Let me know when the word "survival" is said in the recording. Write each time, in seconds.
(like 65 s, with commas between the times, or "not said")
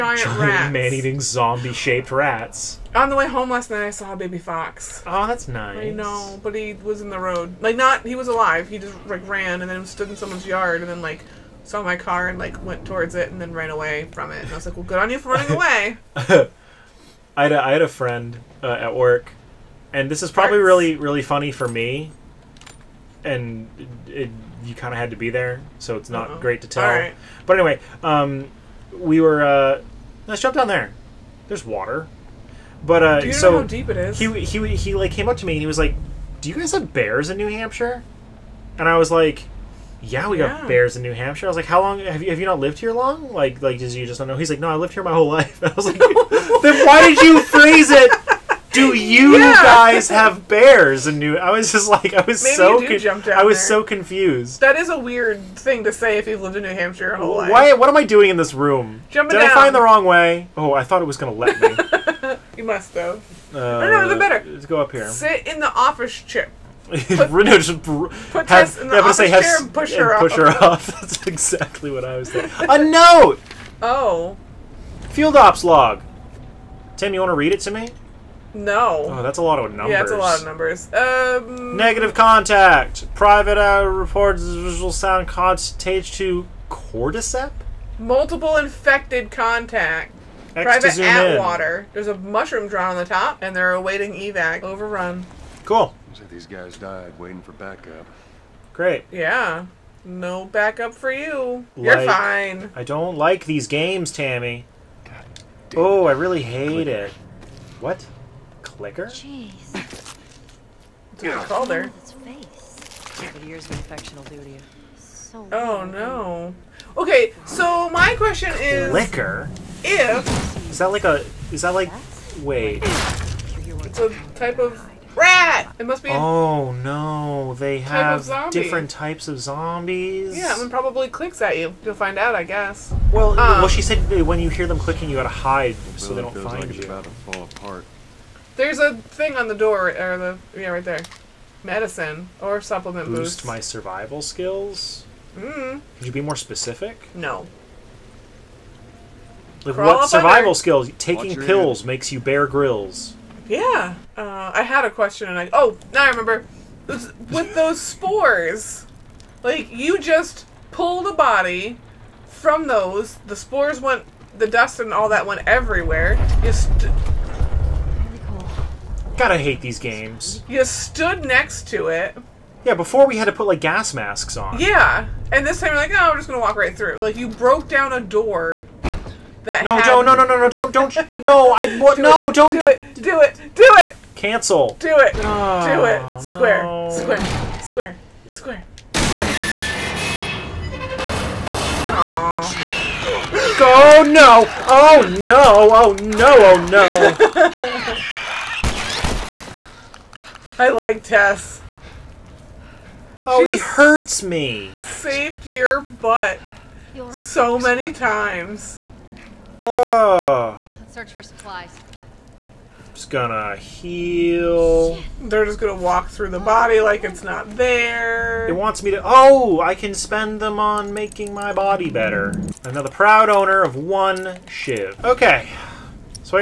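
143 s, 150 s.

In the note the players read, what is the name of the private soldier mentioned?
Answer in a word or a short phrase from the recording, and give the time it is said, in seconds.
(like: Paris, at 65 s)
Atwater, at 90 s.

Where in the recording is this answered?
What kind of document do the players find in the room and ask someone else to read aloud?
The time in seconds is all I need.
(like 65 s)
75 s.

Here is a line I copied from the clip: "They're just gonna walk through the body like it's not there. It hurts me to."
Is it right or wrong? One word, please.
wrong.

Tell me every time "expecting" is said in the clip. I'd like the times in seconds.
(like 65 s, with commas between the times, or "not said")
not said.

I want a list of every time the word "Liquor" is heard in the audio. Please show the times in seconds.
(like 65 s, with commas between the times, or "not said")
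108 s, 118 s.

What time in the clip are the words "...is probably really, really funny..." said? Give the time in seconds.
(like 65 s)
20 s.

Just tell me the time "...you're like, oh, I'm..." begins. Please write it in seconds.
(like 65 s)
175 s.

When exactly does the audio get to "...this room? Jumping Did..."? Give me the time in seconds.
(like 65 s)
58 s.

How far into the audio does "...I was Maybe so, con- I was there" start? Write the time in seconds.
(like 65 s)
52 s.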